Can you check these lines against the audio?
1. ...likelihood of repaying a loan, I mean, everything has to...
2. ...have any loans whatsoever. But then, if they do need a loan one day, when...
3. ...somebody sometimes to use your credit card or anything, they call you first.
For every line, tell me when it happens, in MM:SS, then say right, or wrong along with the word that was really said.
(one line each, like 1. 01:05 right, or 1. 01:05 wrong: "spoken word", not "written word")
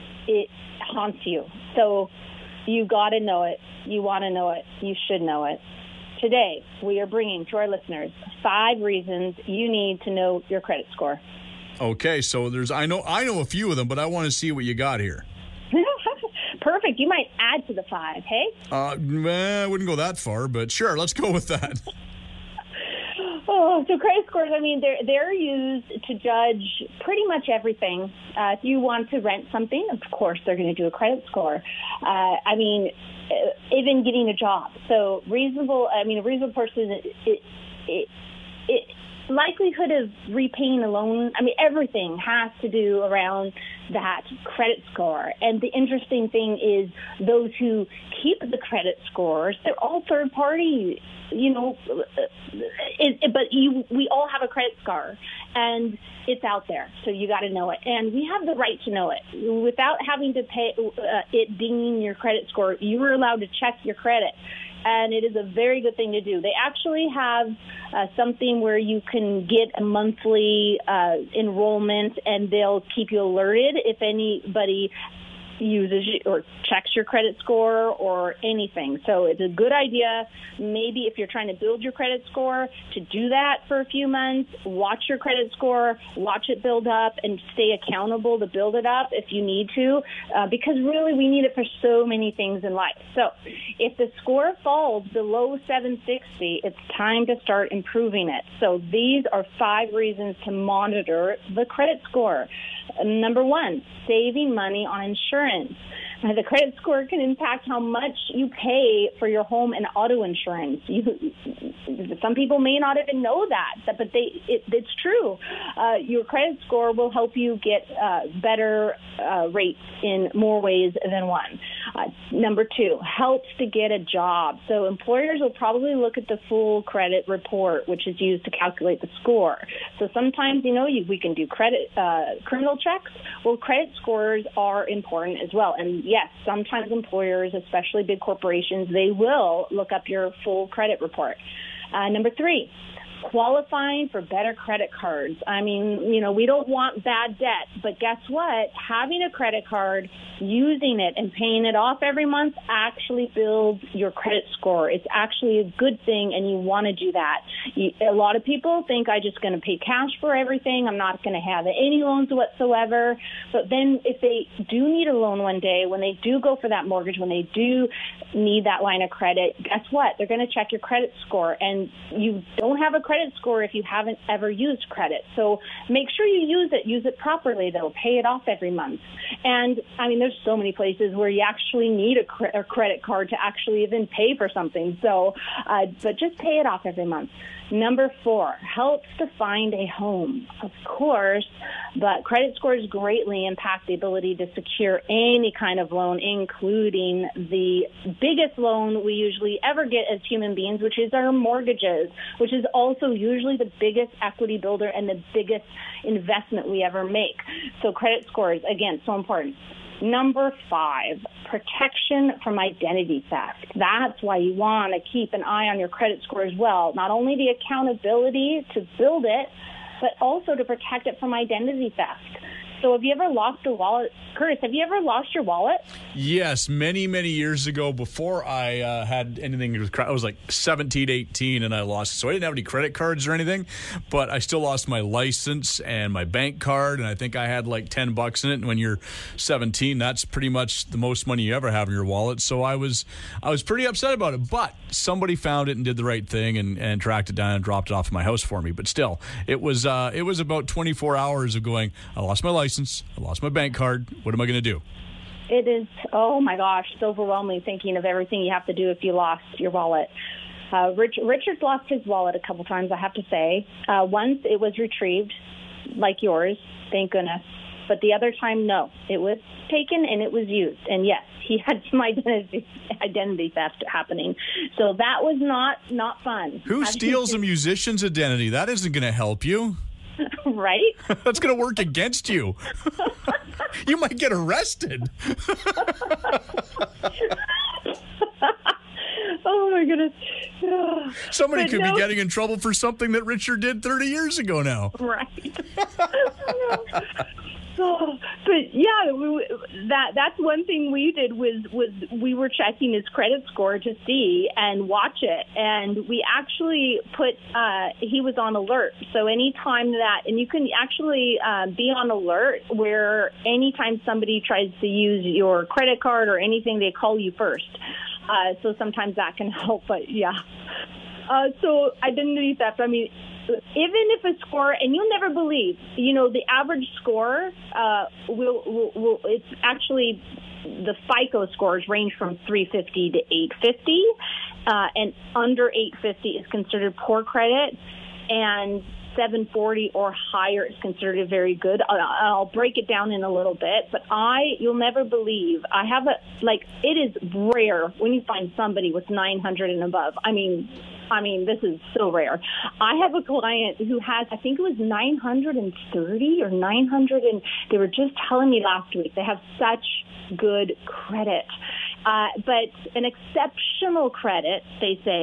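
1. 00:39 right
2. 02:41 right
3. 05:14 wrong: "tries", not "sometimes".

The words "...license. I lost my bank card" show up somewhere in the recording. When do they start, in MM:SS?
04:12.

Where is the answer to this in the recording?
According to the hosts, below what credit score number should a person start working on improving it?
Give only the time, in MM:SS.
01:35.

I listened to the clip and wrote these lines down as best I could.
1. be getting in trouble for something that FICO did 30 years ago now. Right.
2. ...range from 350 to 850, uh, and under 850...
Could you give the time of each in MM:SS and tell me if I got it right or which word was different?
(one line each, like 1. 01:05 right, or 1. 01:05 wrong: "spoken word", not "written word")
1. 04:51 wrong: "Richard", not "FICO"
2. 05:31 right.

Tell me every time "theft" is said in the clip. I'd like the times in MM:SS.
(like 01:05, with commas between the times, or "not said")
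03:33, 03:41, 04:33, 05:22.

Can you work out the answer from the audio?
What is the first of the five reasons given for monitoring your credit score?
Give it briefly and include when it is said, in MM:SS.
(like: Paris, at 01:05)
Saving money on insurance, at 01:44.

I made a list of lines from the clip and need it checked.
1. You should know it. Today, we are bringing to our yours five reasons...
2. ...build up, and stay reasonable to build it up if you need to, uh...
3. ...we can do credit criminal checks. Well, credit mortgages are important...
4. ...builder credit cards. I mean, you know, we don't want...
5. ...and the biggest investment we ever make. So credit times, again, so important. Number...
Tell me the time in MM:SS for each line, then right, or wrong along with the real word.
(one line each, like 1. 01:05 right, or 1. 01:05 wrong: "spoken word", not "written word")
1. 00:04 wrong: "listeners", not "yours"
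2. 01:26 wrong: "accountable", not "reasonable"
3. 02:11 wrong: "scores", not "mortgages"
4. 02:24 wrong: "better", not "builder"
5. 03:24 wrong: "scores", not "times".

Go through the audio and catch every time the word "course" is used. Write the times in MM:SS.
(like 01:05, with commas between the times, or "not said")
00:30, 03:10.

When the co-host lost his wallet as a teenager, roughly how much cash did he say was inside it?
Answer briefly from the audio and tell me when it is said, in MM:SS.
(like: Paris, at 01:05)
10 bucks, at 03:57.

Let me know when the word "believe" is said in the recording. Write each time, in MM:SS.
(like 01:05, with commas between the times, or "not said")
05:25, 05:45.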